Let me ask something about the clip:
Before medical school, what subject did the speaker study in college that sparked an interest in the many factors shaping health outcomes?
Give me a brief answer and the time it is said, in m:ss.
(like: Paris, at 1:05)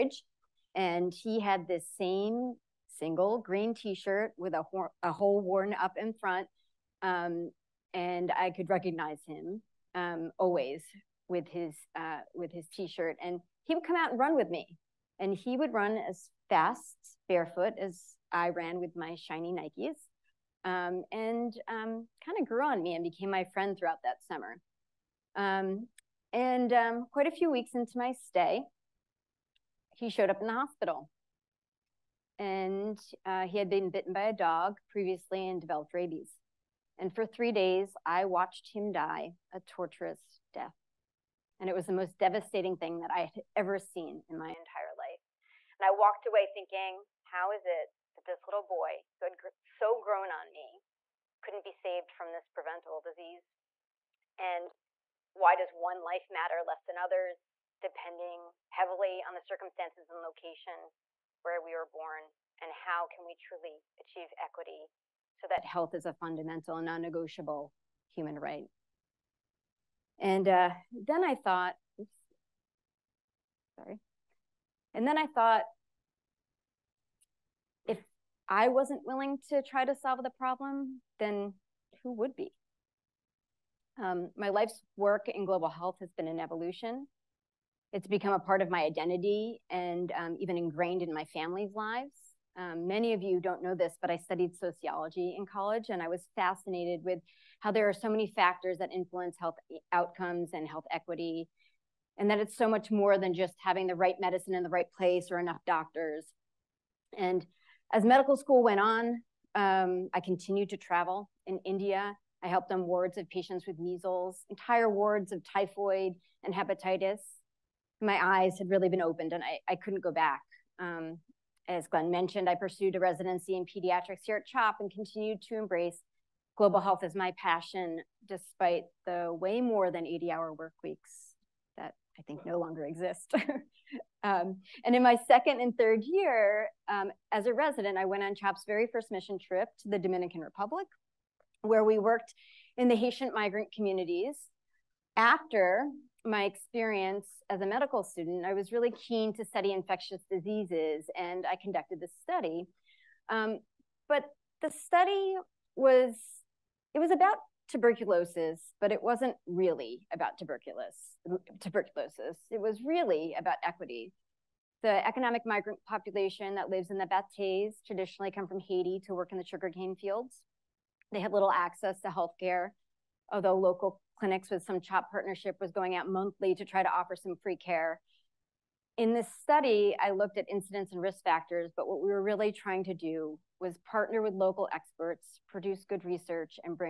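Sociology, at 1:34.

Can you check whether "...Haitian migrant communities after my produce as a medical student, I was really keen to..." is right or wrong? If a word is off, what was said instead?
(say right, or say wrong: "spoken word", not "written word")
wrong: "experience", not "produce".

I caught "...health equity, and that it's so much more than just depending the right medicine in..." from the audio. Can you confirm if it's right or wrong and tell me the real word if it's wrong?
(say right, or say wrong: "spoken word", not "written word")
wrong: "having", not "depending".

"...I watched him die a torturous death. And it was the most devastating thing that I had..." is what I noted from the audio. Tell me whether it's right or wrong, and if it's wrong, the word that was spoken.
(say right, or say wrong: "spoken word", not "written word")
right.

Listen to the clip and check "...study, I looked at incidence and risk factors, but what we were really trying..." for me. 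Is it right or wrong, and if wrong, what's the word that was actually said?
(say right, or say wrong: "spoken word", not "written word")
right.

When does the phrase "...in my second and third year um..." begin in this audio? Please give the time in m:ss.
2:14.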